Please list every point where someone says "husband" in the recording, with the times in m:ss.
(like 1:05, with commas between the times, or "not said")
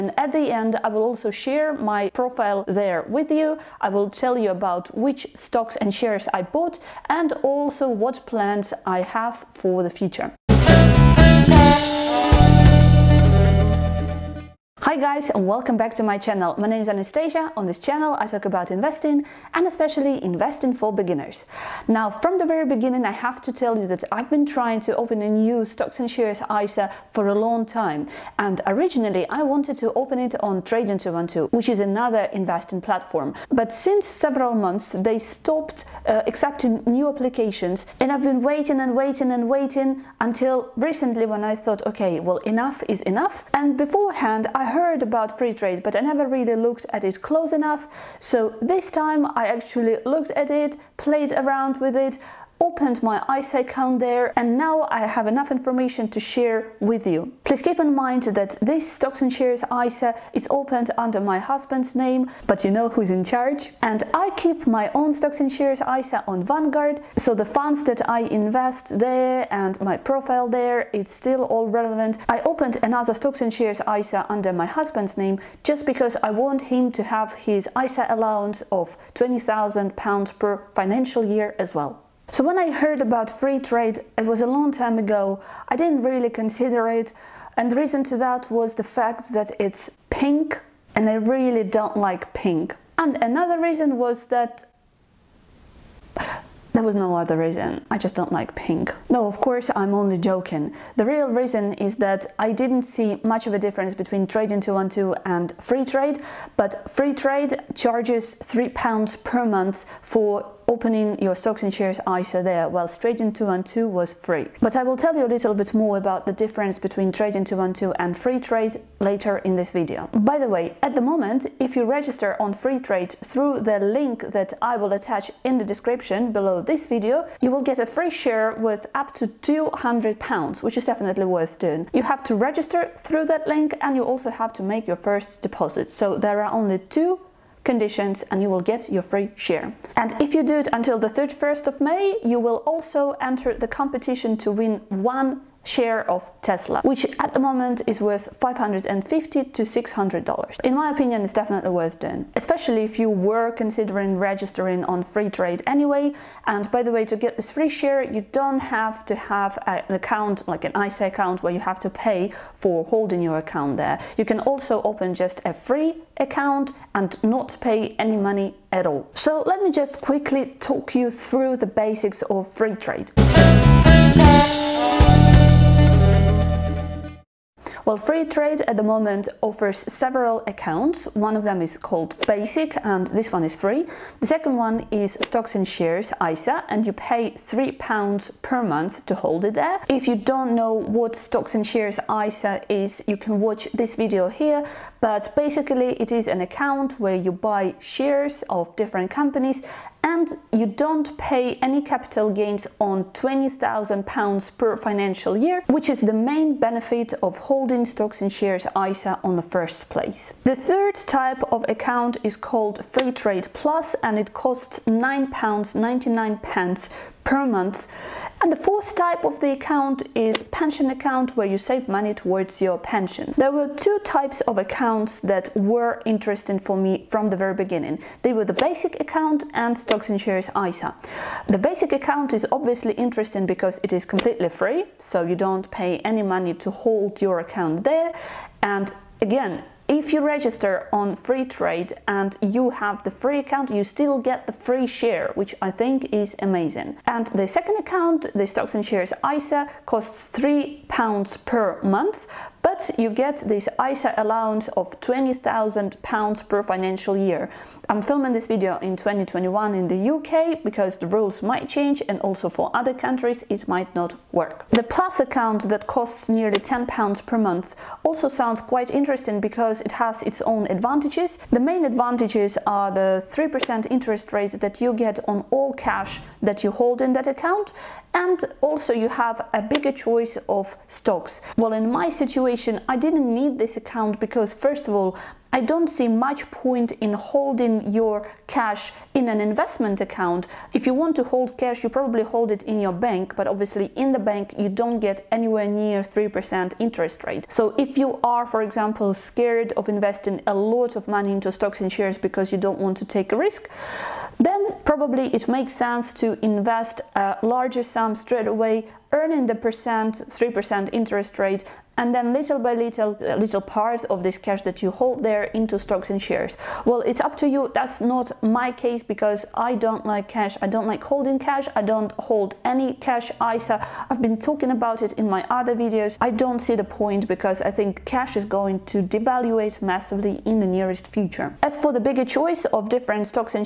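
1:01, 1:14.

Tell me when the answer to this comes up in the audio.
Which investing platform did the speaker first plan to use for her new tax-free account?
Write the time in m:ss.
0:30.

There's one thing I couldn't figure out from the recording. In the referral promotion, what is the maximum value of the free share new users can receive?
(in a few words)
£200.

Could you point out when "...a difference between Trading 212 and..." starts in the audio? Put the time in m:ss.
1:43.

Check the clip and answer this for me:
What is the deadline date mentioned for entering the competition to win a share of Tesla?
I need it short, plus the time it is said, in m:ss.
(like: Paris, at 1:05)
31st of May, at 2:21.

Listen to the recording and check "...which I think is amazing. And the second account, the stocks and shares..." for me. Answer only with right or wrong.
right.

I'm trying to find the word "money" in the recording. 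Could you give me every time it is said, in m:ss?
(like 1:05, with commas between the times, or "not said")
2:48, 3:41, 3:56, 5:01.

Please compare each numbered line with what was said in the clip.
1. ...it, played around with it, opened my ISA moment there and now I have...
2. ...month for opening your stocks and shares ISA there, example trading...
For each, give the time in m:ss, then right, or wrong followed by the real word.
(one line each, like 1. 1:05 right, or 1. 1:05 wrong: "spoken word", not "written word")
1. 0:50 wrong: "account", not "moment"
2. 1:49 wrong: "while", not "example".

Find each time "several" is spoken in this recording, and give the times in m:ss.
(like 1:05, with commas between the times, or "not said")
0:34, 2:59.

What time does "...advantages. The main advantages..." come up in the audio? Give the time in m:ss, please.
4:30.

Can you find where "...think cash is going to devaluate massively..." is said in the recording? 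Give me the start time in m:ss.
5:27.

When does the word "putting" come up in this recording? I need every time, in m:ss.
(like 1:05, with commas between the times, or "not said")
not said.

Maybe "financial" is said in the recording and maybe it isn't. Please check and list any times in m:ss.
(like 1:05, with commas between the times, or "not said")
1:20, 3:24, 4:16.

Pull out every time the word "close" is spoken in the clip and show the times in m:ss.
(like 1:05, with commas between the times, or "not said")
0:47.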